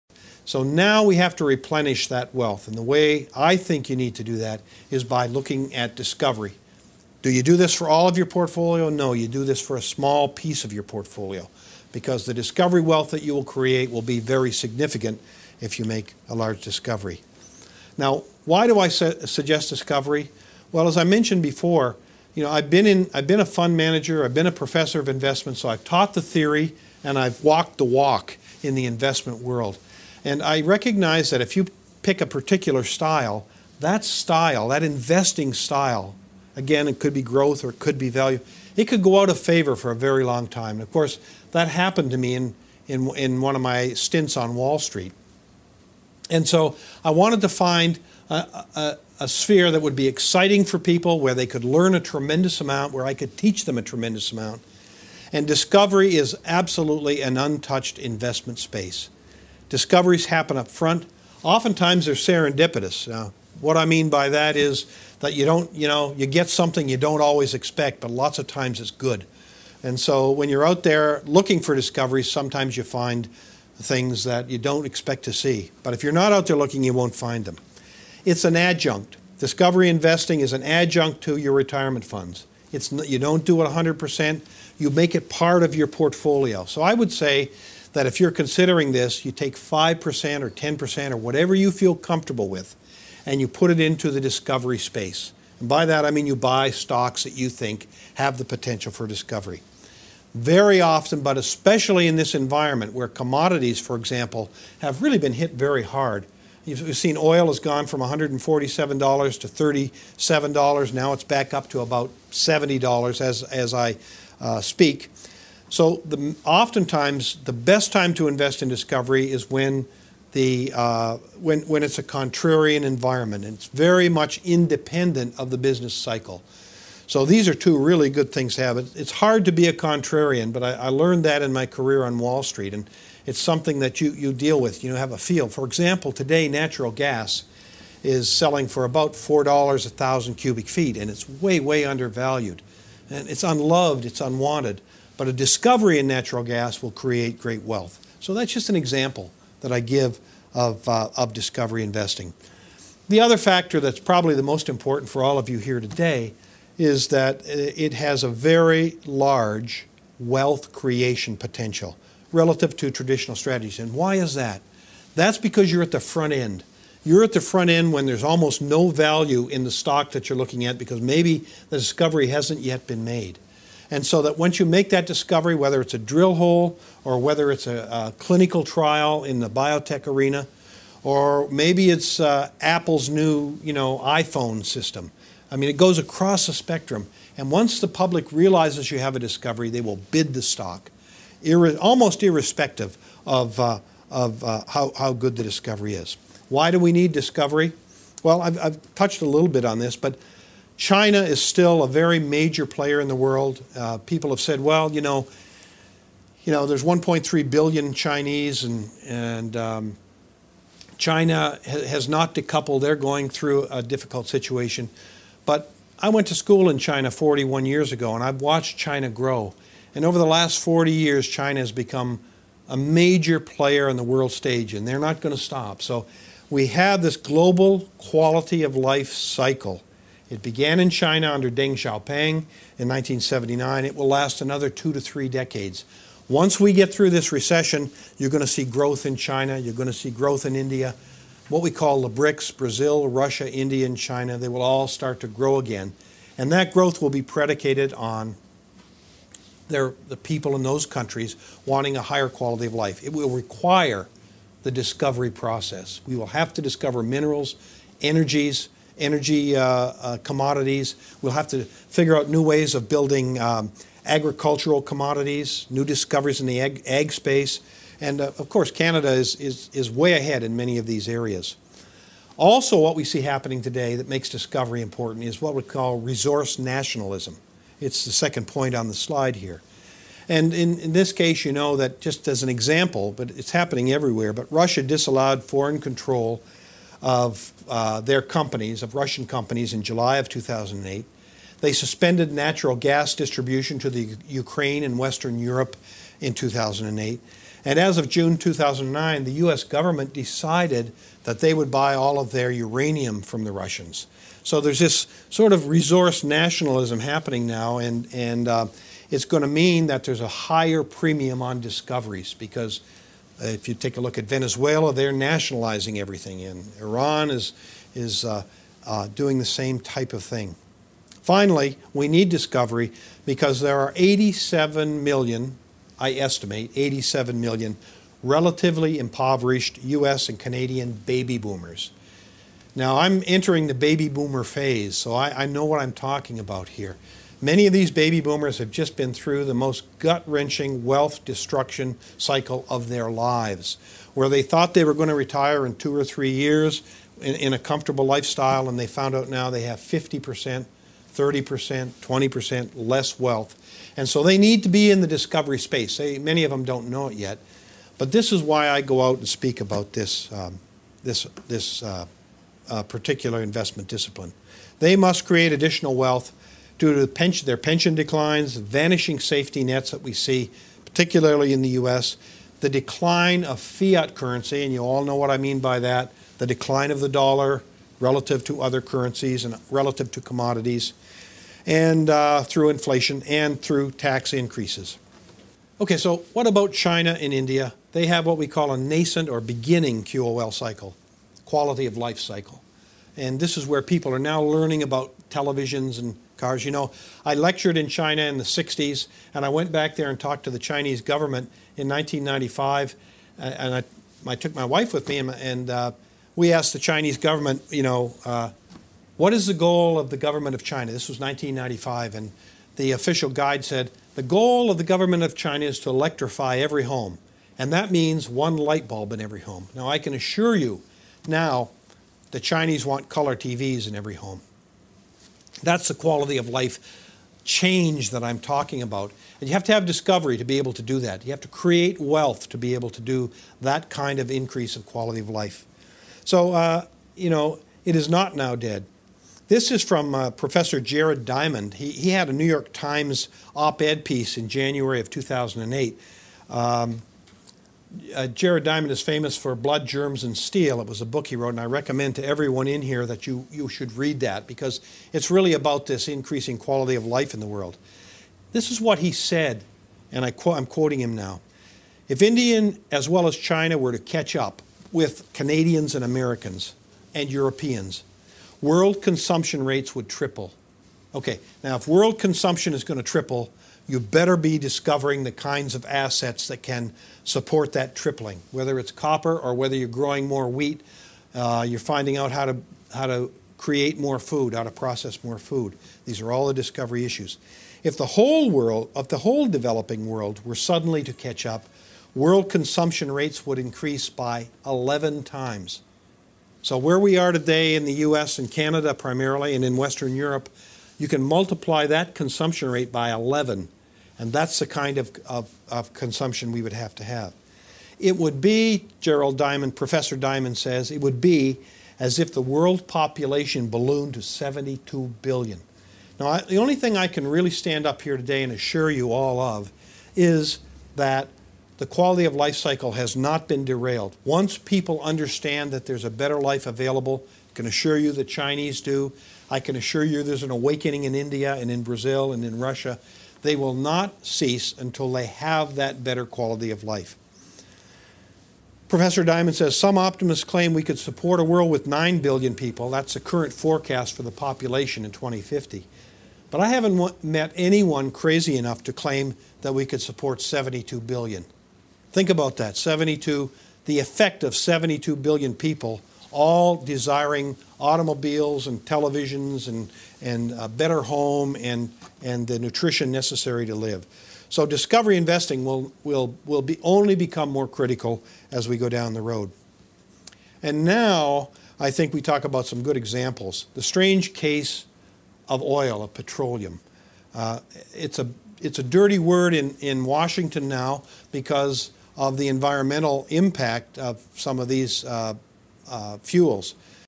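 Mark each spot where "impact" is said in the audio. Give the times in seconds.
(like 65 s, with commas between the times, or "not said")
583 s.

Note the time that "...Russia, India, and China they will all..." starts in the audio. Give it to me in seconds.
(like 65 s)
243 s.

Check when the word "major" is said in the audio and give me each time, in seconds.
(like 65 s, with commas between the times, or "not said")
202 s, 222 s.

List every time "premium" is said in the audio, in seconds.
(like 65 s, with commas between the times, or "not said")
310 s.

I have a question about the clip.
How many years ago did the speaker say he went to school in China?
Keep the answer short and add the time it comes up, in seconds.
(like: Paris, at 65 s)
41, at 217 s.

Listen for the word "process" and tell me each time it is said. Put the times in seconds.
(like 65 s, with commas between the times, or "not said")
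255 s, 484 s.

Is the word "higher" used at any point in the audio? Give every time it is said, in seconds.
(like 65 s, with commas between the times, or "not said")
252 s, 310 s.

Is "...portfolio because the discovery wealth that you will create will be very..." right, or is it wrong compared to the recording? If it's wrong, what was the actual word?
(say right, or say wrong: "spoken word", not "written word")
right.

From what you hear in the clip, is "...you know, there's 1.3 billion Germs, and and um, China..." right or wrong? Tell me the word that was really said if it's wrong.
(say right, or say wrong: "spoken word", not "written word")
wrong: "Chinese", not "Germs".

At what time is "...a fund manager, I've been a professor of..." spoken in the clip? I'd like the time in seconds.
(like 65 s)
23 s.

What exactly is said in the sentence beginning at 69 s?
And so when you're out there looking for discoveries, sometimes you find things that you don't expect to see.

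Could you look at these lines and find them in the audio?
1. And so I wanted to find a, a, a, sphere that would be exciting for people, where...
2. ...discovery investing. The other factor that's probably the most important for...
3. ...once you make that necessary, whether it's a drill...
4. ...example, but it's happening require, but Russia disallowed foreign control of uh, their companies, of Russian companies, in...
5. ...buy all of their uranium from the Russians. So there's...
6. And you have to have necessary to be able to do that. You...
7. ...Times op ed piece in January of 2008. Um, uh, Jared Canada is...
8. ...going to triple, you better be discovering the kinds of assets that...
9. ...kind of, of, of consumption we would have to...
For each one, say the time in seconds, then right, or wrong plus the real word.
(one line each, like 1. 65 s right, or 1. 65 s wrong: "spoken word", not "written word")
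1. 46 s right
2. 151 s right
3. 174 s wrong: "discovery", not "necessary"
4. 282 s wrong: "everywhere", not "require"
5. 301 s right
6. 429 s wrong: "discovery", not "necessary"
7. 442 s wrong: "Diamond", not "Canada"
8. 472 s right
9. 504 s right.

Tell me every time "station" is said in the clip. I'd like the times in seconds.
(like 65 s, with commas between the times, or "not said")
not said.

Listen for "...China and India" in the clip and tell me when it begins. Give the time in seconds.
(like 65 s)
386 s.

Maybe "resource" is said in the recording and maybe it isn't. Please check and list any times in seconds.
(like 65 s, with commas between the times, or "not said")
275 s, 305 s.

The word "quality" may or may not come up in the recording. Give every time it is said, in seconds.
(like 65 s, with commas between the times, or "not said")
227 s, 252 s, 391 s, 425 s, 434 s, 456 s, 521 s, 536 s.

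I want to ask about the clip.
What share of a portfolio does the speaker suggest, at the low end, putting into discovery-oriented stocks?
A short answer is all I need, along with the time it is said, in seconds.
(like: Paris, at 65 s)
5%, at 89 s.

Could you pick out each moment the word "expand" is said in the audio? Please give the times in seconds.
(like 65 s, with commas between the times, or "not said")
not said.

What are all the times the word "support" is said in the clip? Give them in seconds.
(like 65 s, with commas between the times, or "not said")
477 s, 540 s, 550 s.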